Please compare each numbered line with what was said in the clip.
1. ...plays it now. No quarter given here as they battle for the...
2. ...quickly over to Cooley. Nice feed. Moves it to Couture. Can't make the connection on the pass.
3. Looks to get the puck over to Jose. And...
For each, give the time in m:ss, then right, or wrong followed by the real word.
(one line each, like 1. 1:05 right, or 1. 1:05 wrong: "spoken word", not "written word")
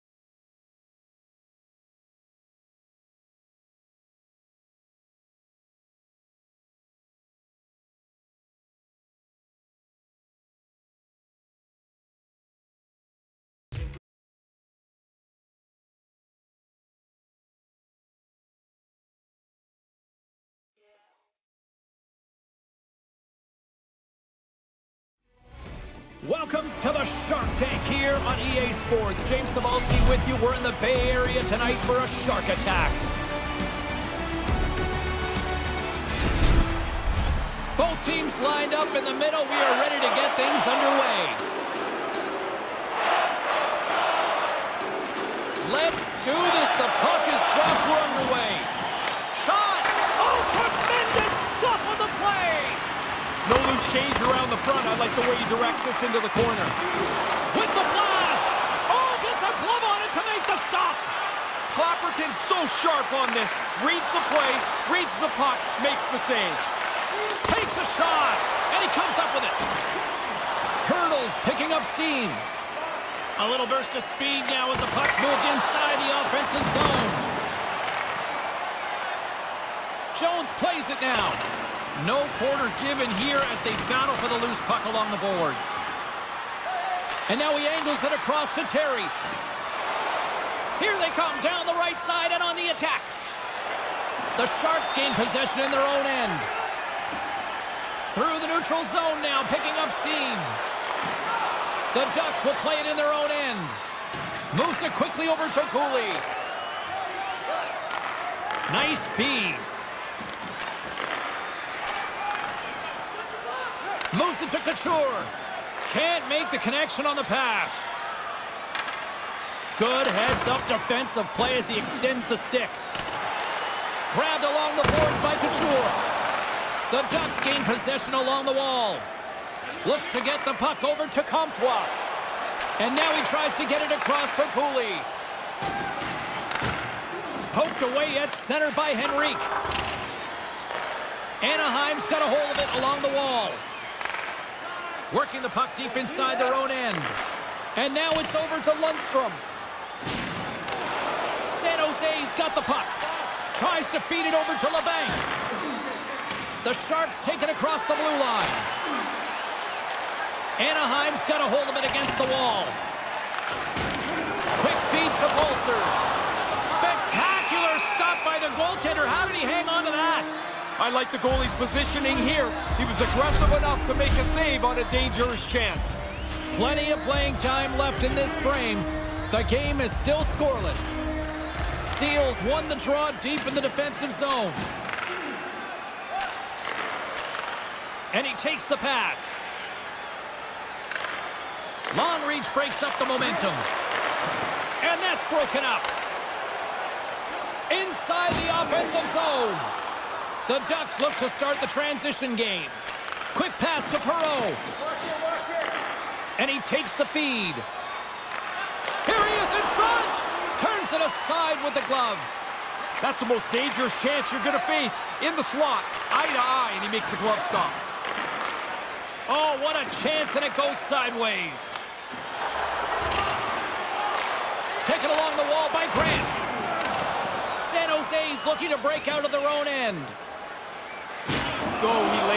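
1. 1:20 right
2. 1:44 right
3. 2:09 wrong: "Comtois", not "Jose".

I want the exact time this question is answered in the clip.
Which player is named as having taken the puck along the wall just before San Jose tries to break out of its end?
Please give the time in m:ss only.
3:45.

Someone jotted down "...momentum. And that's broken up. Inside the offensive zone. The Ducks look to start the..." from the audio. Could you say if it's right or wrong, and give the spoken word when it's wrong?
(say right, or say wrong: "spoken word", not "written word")
right.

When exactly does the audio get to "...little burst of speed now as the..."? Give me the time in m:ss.
1:13.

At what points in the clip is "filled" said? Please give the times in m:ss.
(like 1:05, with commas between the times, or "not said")
not said.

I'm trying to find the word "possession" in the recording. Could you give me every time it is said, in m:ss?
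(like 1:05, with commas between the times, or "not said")
1:35, 2:07.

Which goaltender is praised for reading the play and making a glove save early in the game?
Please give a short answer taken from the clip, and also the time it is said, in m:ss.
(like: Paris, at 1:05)
Clapperton, at 1:01.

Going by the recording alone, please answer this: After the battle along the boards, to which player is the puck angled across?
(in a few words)
Terry.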